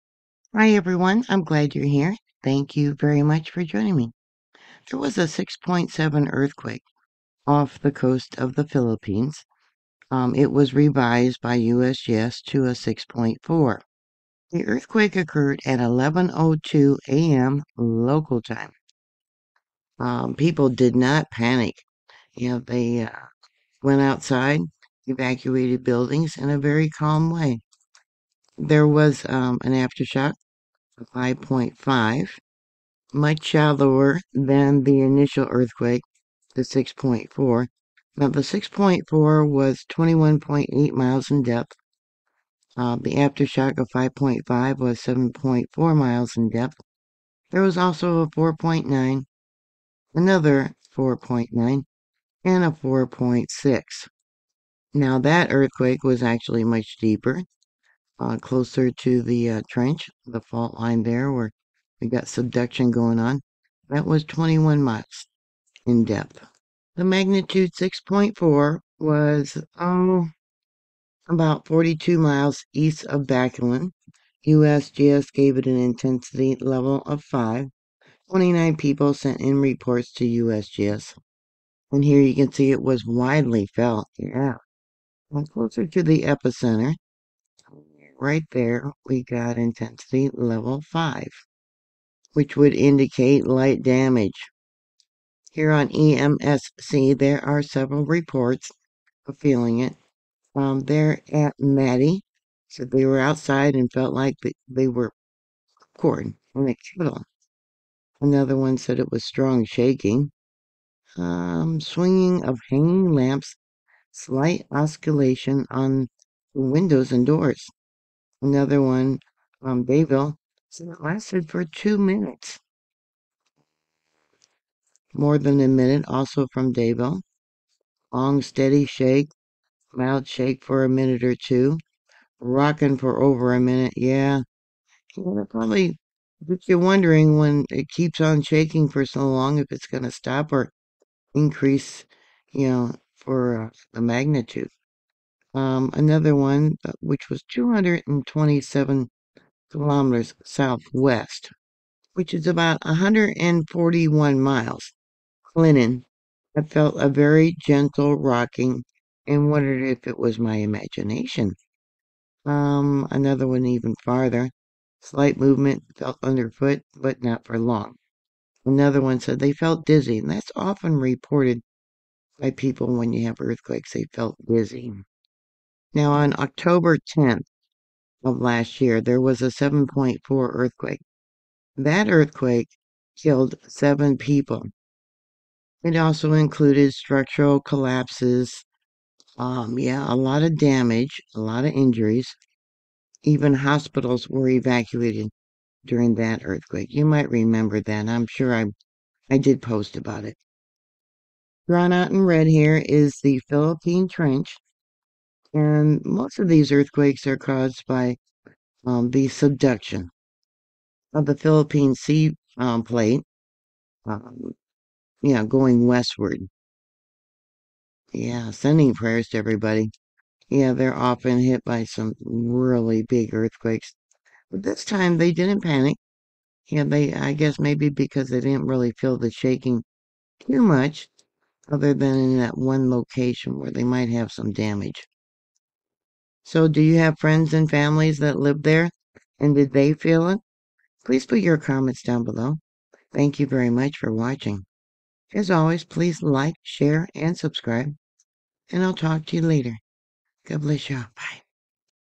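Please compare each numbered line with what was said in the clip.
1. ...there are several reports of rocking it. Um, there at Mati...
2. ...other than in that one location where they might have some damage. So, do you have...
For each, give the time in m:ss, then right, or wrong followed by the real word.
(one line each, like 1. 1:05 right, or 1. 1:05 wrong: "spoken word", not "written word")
1. 1:37 wrong: "feeling", not "rocking"
2. 3:51 right.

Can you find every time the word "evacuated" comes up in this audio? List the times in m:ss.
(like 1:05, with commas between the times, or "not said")
0:25, 3:14.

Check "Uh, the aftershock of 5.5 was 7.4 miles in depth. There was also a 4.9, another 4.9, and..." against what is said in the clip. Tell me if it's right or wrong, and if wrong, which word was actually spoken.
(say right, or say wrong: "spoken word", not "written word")
right.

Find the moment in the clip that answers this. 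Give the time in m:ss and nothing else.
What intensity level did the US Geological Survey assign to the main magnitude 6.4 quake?
1:15.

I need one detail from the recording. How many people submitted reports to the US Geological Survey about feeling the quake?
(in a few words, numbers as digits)
29.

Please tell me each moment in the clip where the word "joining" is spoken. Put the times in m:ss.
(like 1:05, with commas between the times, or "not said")
0:03.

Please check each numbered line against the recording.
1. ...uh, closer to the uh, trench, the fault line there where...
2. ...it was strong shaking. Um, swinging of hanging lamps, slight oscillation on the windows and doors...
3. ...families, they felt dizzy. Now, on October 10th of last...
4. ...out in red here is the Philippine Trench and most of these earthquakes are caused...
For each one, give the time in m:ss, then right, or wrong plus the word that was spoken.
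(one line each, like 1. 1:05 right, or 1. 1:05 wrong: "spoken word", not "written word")
1. 0:58 right
2. 1:48 right
3. 2:53 wrong: "earthquakes", not "families"
4. 3:21 right.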